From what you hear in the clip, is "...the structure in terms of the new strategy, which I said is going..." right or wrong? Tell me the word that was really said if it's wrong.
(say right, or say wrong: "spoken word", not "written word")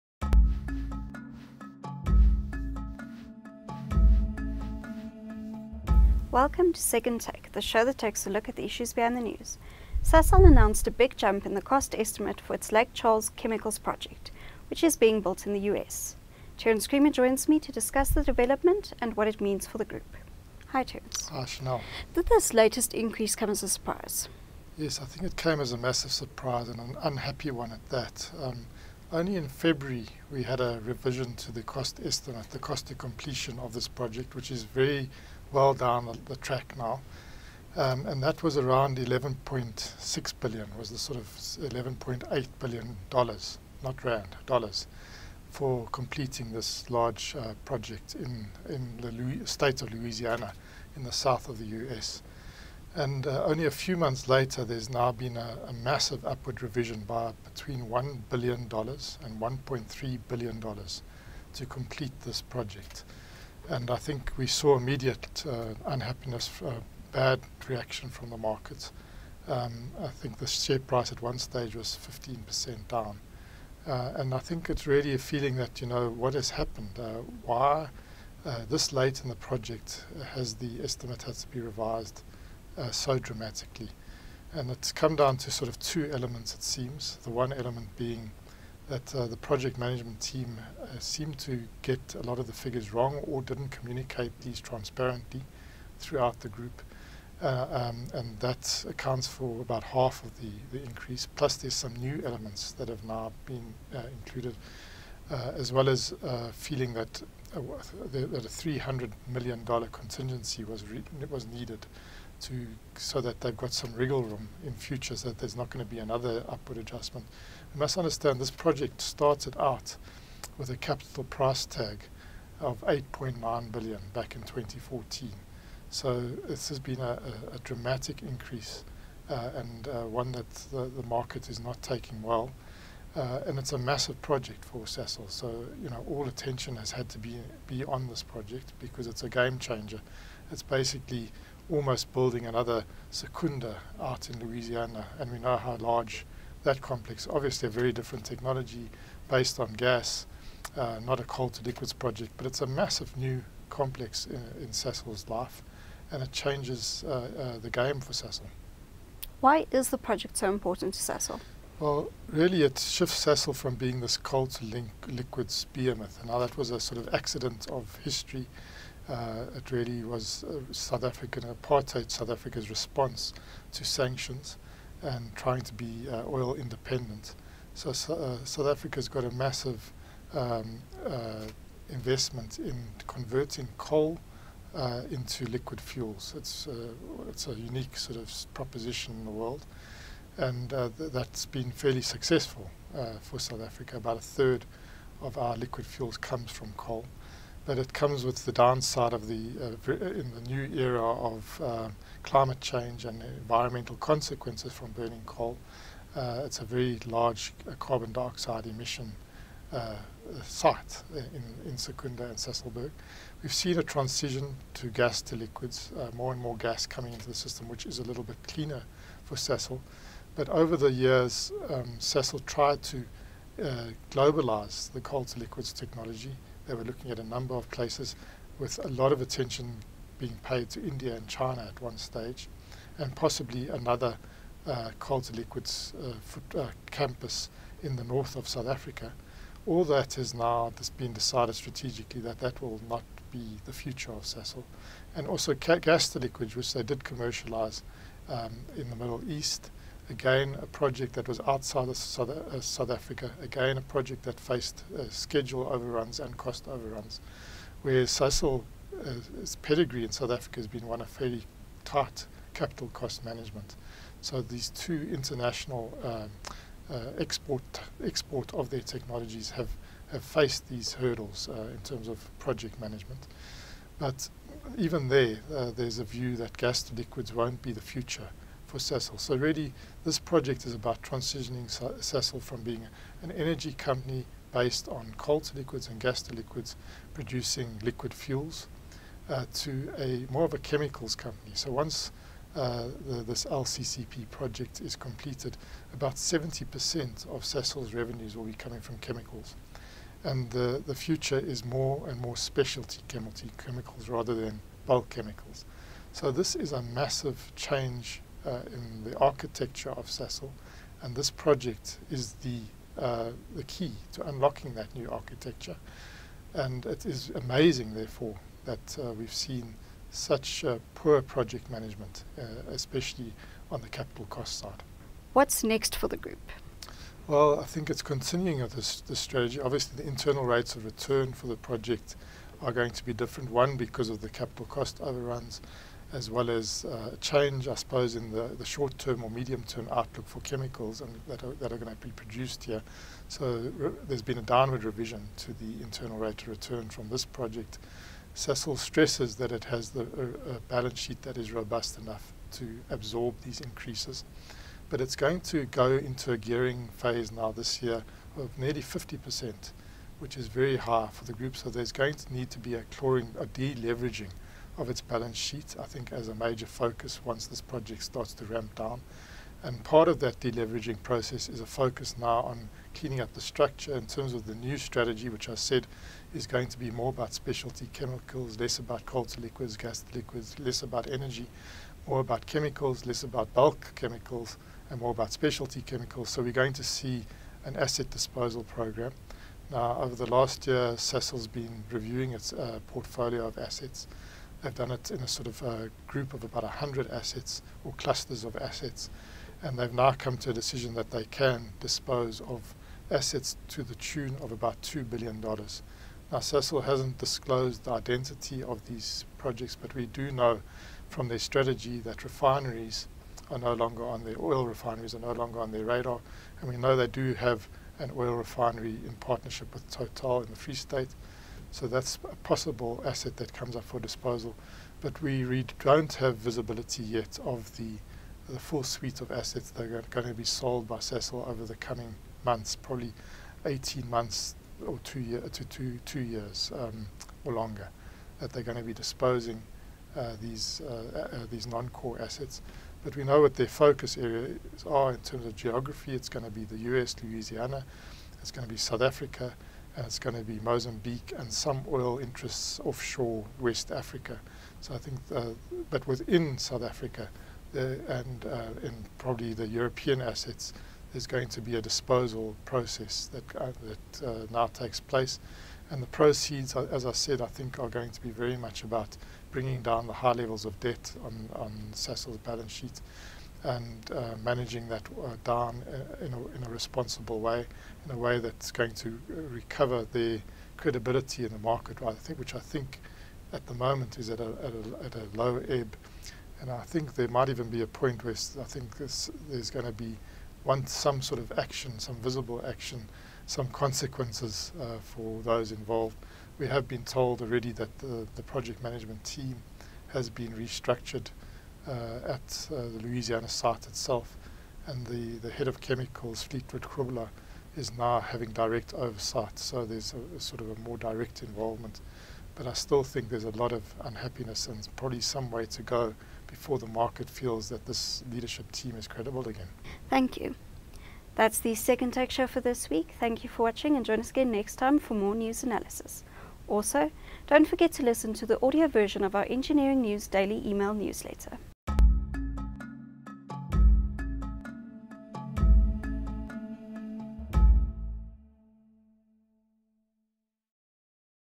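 right.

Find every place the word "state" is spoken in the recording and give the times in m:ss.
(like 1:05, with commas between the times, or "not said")
0:49, 7:00.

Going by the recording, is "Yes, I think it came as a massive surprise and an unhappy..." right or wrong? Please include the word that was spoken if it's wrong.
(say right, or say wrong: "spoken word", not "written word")
right.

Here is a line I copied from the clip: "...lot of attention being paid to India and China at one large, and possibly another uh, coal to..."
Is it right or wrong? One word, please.
wrong.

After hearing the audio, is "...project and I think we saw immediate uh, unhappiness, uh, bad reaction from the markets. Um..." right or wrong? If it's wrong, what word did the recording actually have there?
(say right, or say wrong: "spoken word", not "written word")
right.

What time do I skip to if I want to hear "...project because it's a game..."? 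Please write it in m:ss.
2:18.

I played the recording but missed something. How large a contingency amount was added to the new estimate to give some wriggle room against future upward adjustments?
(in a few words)
$300 million.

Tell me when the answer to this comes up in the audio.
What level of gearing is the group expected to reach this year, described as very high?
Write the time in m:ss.
5:58.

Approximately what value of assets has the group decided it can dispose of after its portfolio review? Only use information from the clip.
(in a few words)
$2 billion.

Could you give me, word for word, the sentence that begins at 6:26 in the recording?
So we're going to see an asset disposal program.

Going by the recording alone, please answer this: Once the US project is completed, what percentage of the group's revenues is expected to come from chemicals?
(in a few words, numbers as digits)
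70%.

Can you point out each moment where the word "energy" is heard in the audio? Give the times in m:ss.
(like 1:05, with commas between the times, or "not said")
4:43, 6:21.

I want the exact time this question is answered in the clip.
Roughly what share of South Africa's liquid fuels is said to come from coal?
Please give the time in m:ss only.
3:13.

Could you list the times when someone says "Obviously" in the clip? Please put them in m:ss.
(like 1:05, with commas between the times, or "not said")
2:27, 5:29.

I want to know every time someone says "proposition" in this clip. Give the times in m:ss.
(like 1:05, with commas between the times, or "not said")
3:08.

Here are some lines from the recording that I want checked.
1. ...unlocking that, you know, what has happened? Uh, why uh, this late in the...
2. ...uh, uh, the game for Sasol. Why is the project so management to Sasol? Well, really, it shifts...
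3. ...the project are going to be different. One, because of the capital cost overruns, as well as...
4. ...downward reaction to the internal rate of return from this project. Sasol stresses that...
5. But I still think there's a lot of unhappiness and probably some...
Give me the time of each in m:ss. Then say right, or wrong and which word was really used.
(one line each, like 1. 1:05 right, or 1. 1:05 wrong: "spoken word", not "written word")
1. 1:15 wrong: "feeling", not "unlocking"
2. 2:37 wrong: "important", not "management"
3. 5:31 right
4. 5:44 wrong: "revision", not "reaction"
5. 8:32 right.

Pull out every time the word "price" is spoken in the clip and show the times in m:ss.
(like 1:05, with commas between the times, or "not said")
1:10, 2:01.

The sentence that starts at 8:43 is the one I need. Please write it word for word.
Thank you for watching and join us again next time for more news analysis.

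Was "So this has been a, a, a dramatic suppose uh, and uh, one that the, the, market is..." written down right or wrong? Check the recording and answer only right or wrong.
wrong.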